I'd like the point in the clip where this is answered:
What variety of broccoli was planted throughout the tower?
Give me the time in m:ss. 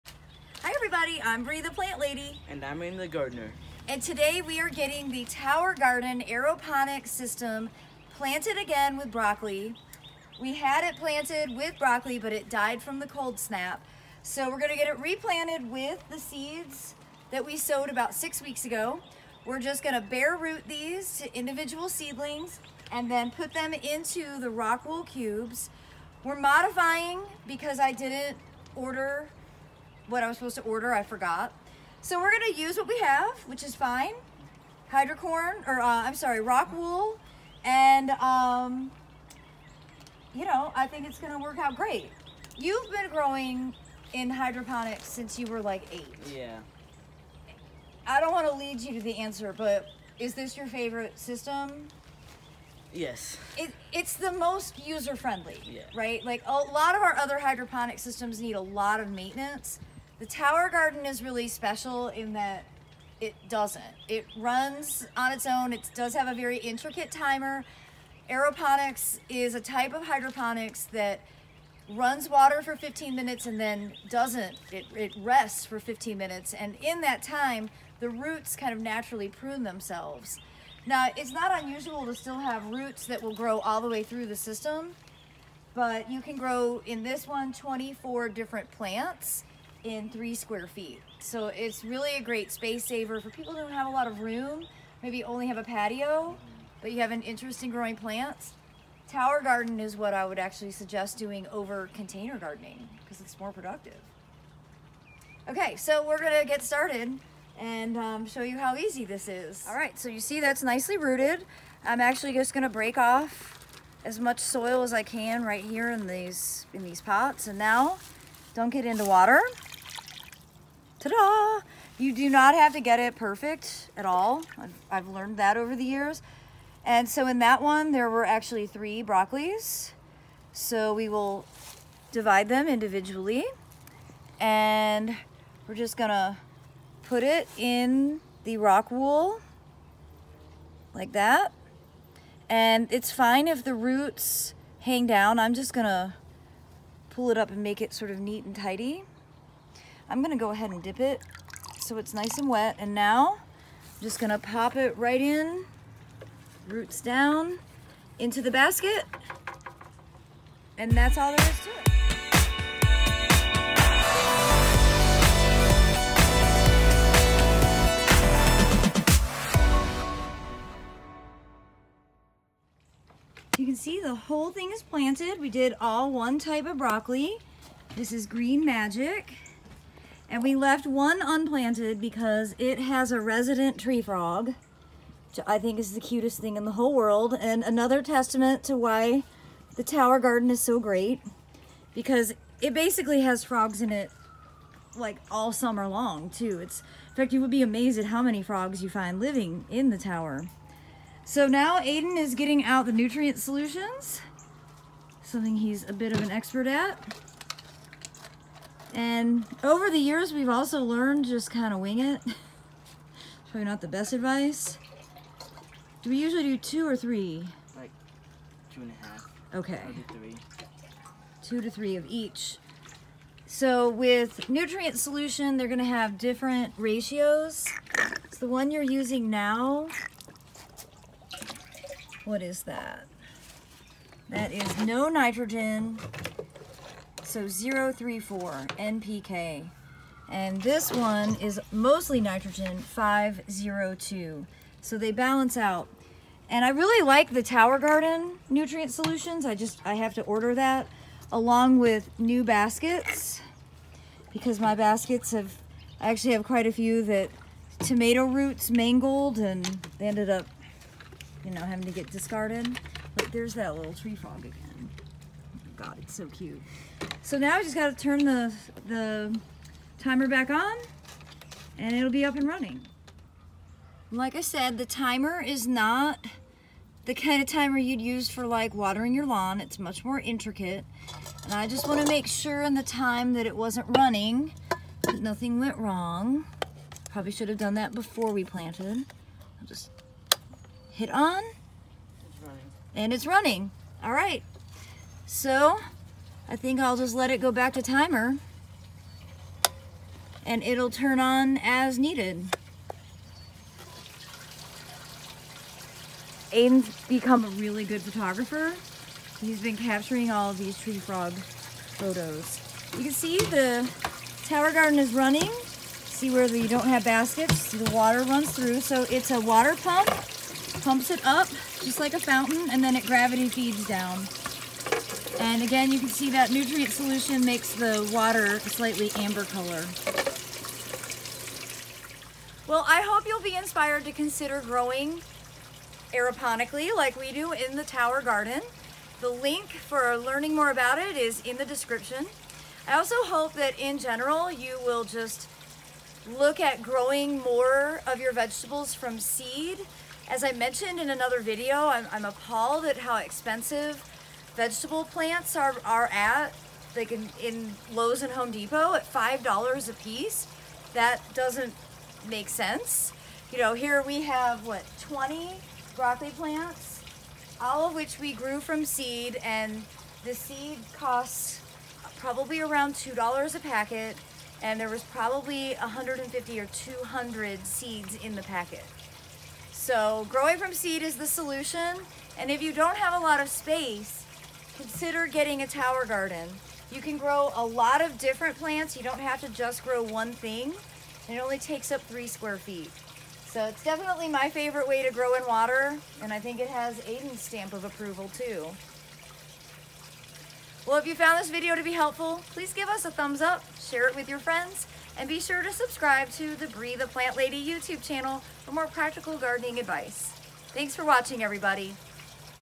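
2:58.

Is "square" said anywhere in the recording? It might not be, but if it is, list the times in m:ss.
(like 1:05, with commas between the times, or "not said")
1:30, 6:32.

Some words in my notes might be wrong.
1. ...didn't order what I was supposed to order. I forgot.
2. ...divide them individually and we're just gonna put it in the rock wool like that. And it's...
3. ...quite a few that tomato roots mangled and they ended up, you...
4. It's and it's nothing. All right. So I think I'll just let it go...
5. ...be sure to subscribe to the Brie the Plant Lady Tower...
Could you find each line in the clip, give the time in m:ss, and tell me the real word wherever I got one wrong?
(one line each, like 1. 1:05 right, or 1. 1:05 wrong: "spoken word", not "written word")
1. 0:27 right
2. 2:12 right
3. 4:16 right
4. 4:51 wrong: "running", not "nothing"
5. 6:45 wrong: "YouTube", not "Tower".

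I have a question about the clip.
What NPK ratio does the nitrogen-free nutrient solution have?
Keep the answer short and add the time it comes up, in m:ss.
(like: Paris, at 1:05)
0-3-4, at 3:57.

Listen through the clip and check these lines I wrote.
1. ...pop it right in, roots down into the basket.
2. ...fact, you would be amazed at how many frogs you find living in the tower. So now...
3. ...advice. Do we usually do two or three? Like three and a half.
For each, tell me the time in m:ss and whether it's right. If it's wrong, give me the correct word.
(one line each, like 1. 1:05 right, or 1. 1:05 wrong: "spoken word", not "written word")
1. 2:34 right
2. 3:17 right
3. 3:34 wrong: "two", not "three".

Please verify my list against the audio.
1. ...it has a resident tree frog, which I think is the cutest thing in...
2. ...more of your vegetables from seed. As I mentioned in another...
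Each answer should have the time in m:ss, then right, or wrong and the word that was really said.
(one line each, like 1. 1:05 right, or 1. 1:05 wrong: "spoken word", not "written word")
1. 3:02 right
2. 5:47 right.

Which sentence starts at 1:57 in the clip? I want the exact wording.
And now don't get into water ta-da!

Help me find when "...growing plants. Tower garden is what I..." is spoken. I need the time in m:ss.
1:37.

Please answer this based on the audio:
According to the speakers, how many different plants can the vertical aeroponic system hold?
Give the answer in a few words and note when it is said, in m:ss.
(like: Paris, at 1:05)
24, at 1:27.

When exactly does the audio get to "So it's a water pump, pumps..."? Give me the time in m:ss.
5:18.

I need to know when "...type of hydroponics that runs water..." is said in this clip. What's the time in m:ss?
1:09.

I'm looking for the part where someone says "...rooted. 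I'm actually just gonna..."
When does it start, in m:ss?
1:50.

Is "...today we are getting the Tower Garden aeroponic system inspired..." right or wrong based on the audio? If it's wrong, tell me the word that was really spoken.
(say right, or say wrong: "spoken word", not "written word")
wrong: "planted", not "inspired".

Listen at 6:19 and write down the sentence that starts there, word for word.
So growing from seed is the solution.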